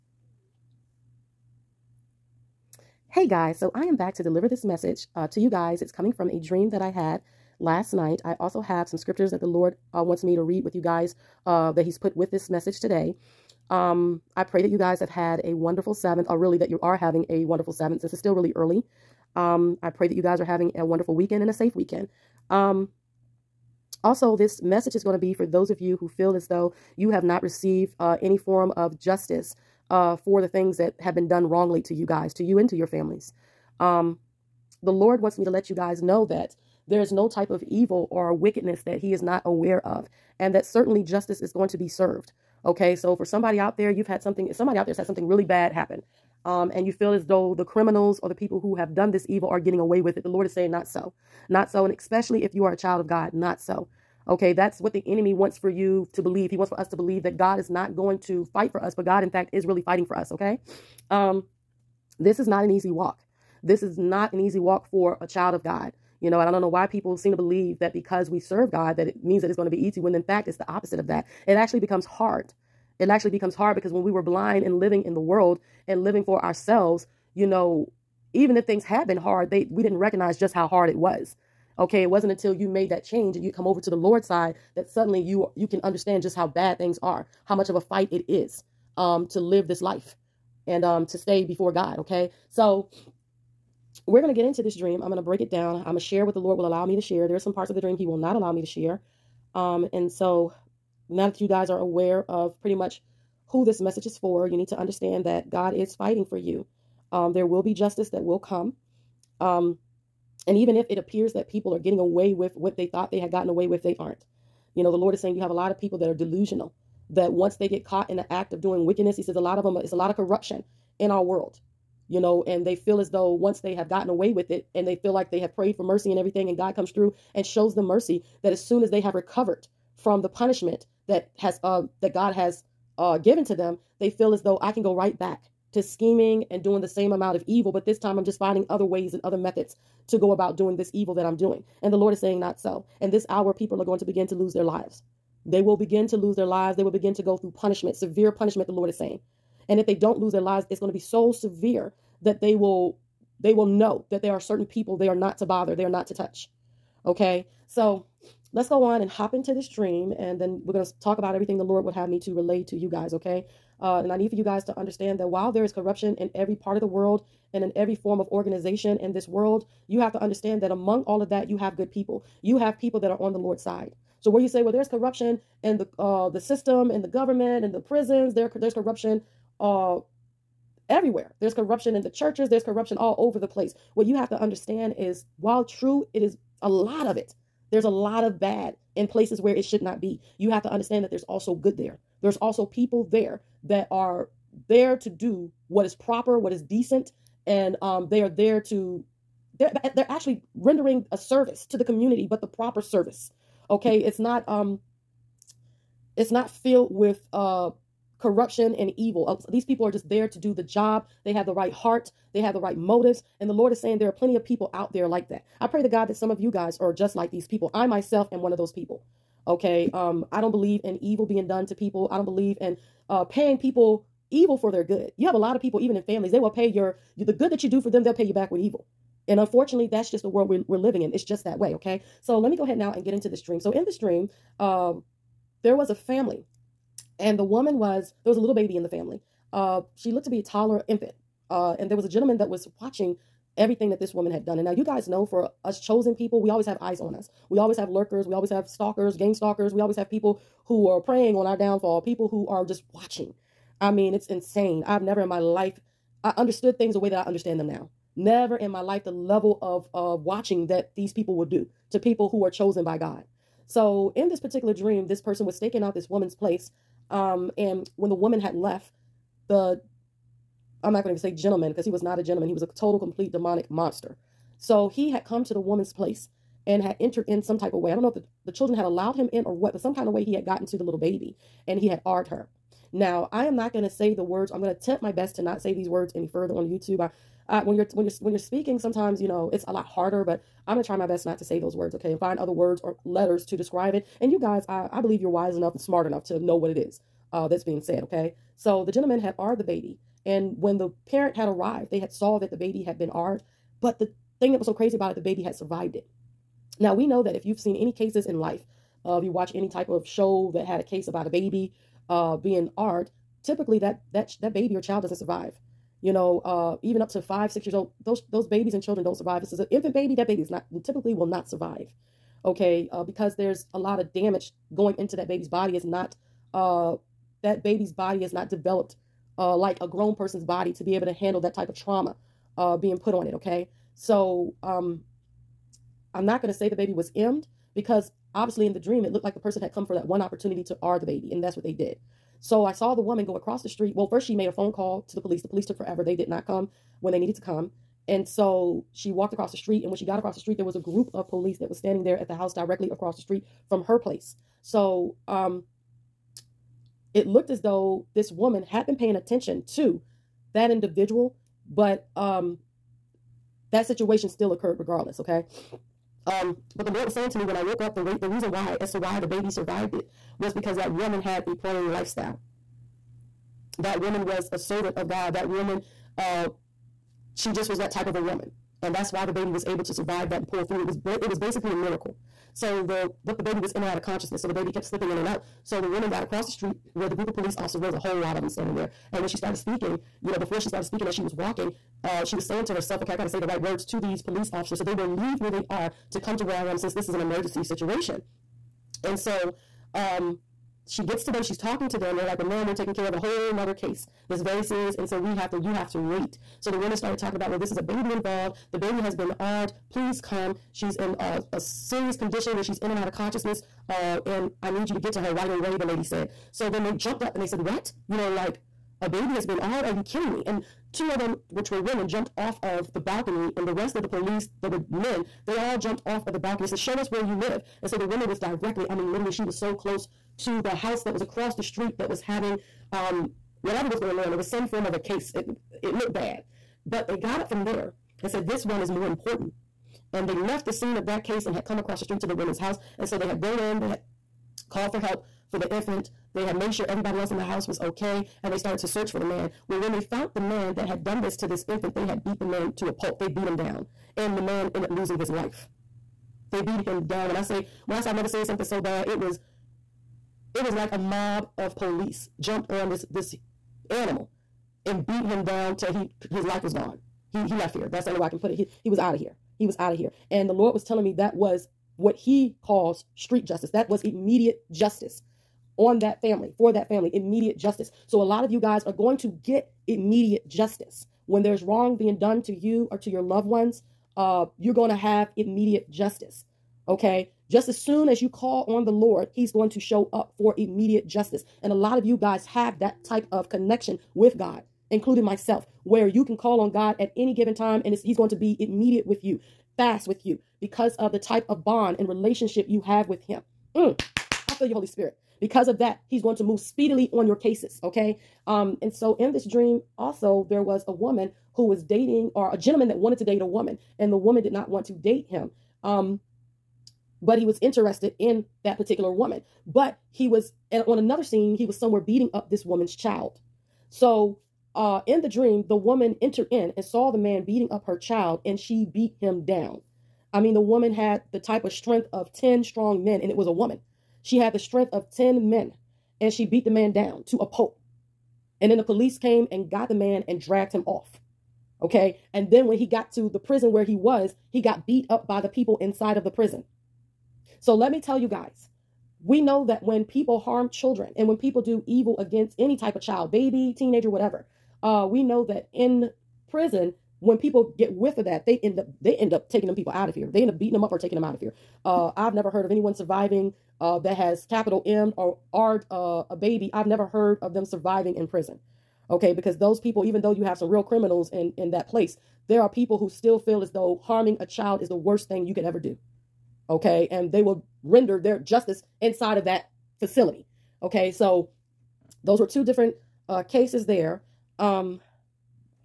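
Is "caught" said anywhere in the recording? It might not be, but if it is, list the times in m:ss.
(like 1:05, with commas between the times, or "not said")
1:57.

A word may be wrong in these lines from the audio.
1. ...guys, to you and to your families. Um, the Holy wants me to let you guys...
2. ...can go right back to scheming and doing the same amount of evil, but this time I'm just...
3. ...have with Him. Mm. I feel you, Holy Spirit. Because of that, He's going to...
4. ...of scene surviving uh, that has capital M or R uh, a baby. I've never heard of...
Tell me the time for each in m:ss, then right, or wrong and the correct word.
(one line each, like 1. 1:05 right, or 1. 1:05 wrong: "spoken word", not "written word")
1. 0:32 wrong: "Lord", not "Holy"
2. 2:14 right
3. 8:22 right
4. 9:22 wrong: "anyone", not "scene".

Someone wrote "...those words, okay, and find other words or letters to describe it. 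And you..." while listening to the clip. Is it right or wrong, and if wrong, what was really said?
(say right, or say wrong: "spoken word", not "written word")
right.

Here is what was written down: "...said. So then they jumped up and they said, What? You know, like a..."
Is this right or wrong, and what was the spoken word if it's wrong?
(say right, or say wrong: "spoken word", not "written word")
right.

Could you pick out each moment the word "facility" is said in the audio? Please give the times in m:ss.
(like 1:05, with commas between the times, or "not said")
9:39.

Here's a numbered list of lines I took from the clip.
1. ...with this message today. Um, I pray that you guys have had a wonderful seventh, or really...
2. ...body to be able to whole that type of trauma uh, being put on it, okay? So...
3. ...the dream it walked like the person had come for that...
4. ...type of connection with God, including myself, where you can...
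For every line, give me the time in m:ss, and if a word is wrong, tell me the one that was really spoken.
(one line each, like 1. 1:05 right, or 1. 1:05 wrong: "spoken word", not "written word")
1. 0:12 right
2. 5:30 wrong: "handle", not "whole"
3. 5:38 wrong: "looked", not "walked"
4. 8:13 right.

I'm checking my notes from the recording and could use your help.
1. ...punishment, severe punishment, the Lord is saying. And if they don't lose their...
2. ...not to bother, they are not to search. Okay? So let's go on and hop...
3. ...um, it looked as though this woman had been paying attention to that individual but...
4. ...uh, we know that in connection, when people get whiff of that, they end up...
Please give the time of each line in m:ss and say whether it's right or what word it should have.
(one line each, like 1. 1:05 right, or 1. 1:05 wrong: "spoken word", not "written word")
1. 2:27 right
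2. 2:35 wrong: "touch", not "search"
3. 5:55 right
4. 9:14 wrong: "prison", not "connection".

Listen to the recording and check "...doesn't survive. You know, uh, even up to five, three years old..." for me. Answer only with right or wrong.
wrong.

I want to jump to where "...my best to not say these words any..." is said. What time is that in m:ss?
4:45.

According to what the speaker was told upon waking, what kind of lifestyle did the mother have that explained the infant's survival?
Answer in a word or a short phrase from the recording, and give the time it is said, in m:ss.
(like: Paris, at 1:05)
a praying lifestyle, at 6:11.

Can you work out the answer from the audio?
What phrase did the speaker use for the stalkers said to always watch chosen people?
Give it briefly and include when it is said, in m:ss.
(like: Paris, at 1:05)
game stalkers, at 4:09.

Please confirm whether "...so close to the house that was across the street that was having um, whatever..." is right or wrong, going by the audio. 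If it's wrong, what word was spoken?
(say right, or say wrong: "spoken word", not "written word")
right.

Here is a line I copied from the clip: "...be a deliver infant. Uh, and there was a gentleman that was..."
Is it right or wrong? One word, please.
wrong.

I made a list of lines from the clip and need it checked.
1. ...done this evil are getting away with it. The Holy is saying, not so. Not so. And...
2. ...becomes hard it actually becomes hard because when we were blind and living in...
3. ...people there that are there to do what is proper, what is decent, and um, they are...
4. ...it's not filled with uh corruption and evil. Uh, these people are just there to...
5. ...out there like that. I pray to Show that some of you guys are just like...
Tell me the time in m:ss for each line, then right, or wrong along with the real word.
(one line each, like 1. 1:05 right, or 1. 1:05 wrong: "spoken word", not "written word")
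1. 0:48 wrong: "Lord", not "Holy"
2. 1:11 right
3. 3:12 right
4. 3:26 right
5. 3:34 wrong: "God", not "Show".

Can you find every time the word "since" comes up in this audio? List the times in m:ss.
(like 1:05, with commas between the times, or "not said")
0:17, 6:36.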